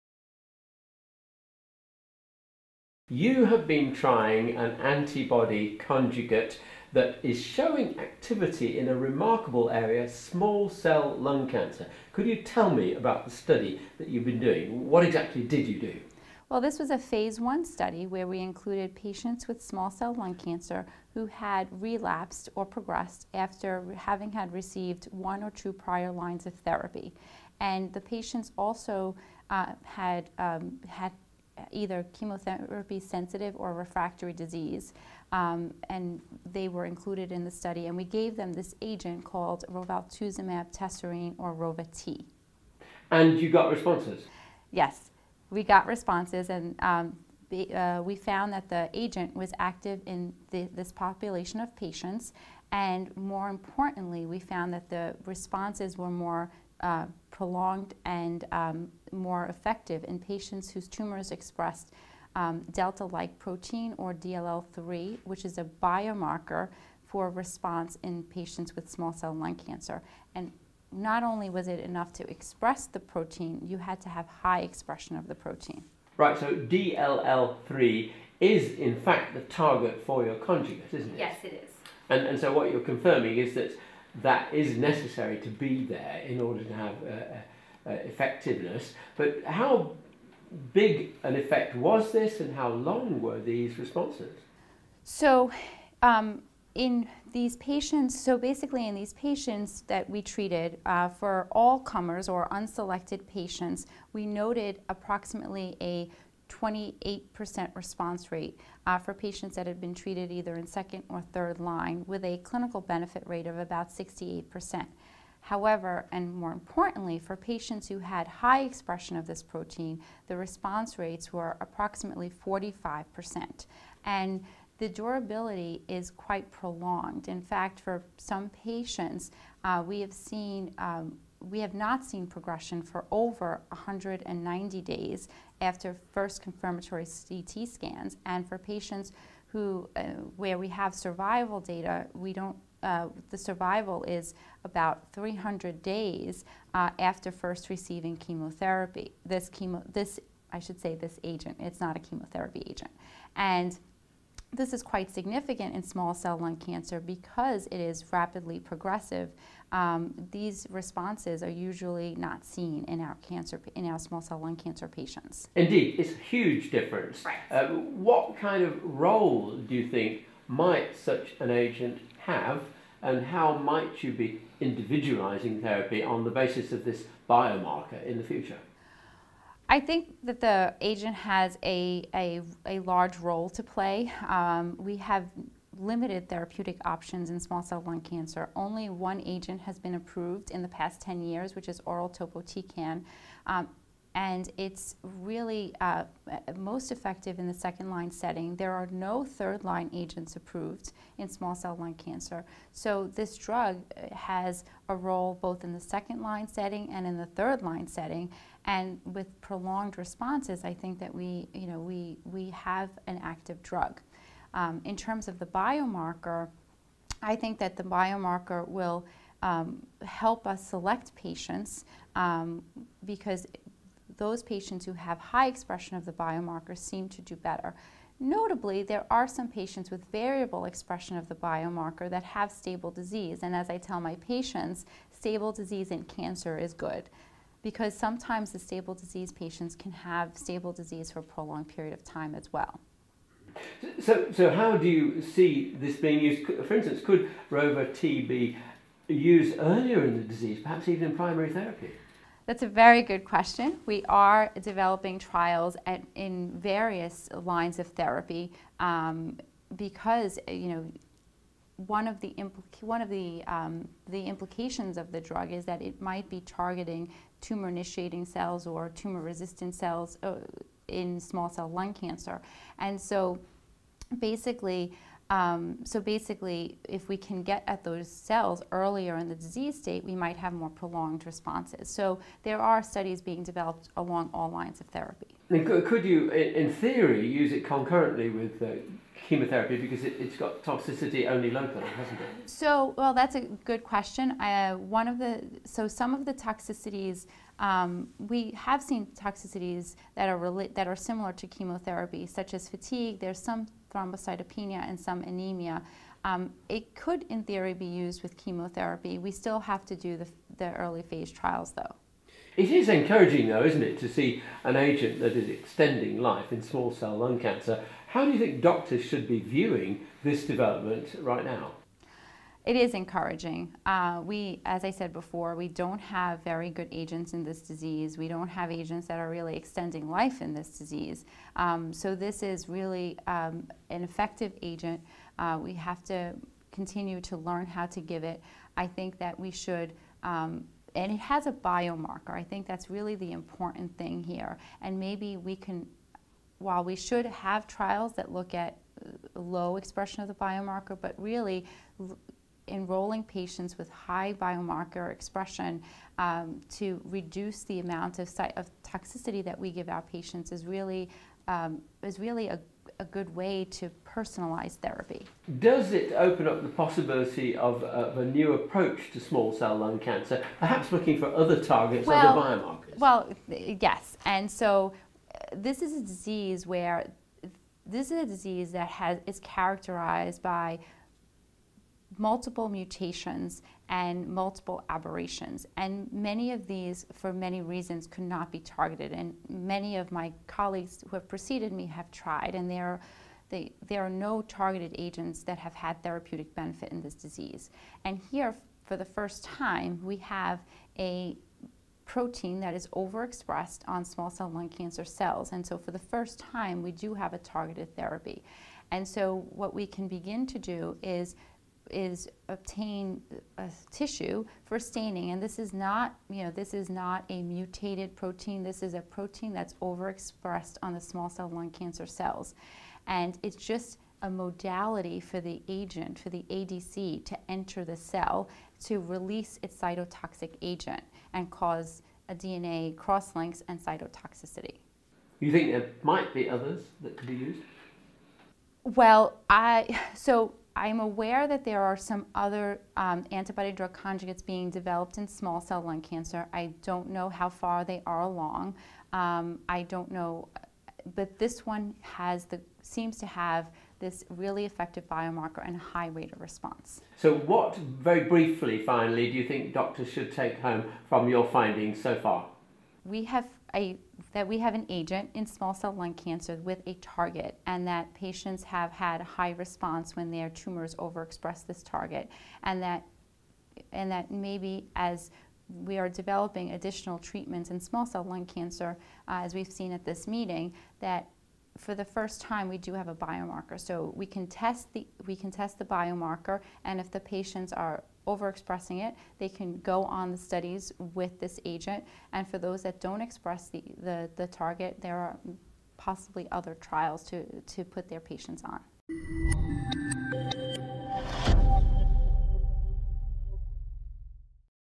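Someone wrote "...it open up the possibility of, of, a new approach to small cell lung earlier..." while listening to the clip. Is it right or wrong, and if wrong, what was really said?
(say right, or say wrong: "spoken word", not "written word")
wrong: "cancer", not "earlier".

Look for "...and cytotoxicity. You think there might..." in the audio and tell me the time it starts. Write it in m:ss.
7:13.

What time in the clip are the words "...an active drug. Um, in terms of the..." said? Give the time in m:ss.
3:33.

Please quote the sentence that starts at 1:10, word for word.
And not only was it enough to express the protein, you had to have high expression of the protein.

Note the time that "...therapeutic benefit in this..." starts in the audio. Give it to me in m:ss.
6:36.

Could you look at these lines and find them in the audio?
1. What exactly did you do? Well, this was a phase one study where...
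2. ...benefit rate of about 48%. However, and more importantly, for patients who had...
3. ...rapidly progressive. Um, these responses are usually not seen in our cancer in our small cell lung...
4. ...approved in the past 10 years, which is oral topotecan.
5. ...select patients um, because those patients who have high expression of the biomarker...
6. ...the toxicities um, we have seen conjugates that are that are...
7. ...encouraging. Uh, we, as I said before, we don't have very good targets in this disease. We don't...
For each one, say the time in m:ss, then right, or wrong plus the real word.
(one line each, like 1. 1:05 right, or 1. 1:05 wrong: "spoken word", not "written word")
1. 0:14 right
2. 1:52 wrong: "68", not "48"
3. 2:38 right
4. 3:09 right
5. 3:40 right
6. 4:56 wrong: "toxicities", not "conjugates"
7. 5:22 wrong: "agents", not "targets".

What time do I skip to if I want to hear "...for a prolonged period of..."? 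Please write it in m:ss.
4:01.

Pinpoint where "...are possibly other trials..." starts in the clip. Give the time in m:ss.
8:15.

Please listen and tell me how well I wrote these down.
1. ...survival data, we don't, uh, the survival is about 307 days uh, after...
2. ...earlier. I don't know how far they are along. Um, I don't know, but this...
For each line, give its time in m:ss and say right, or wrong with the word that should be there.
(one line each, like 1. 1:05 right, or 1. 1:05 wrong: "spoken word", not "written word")
1. 2:20 wrong: "300", not "307"
2. 7:26 wrong: "cancer", not "earlier".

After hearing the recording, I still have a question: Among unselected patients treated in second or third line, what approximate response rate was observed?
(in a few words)
28%.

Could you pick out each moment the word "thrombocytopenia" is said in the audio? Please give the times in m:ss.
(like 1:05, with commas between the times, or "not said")
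5:03.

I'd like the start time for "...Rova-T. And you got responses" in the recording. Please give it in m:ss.
0:41.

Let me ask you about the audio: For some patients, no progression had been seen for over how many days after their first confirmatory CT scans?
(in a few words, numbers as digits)
190 days.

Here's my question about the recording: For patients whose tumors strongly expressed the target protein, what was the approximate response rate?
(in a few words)
45%.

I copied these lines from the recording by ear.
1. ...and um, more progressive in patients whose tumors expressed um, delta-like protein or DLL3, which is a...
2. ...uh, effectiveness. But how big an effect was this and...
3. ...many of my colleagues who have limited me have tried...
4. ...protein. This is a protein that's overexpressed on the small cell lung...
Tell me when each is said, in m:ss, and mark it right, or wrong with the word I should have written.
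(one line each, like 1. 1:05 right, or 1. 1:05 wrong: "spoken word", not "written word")
1. 0:58 wrong: "effective", not "progressive"
2. 1:27 right
3. 6:29 wrong: "preceded", not "limited"
4. 6:58 right.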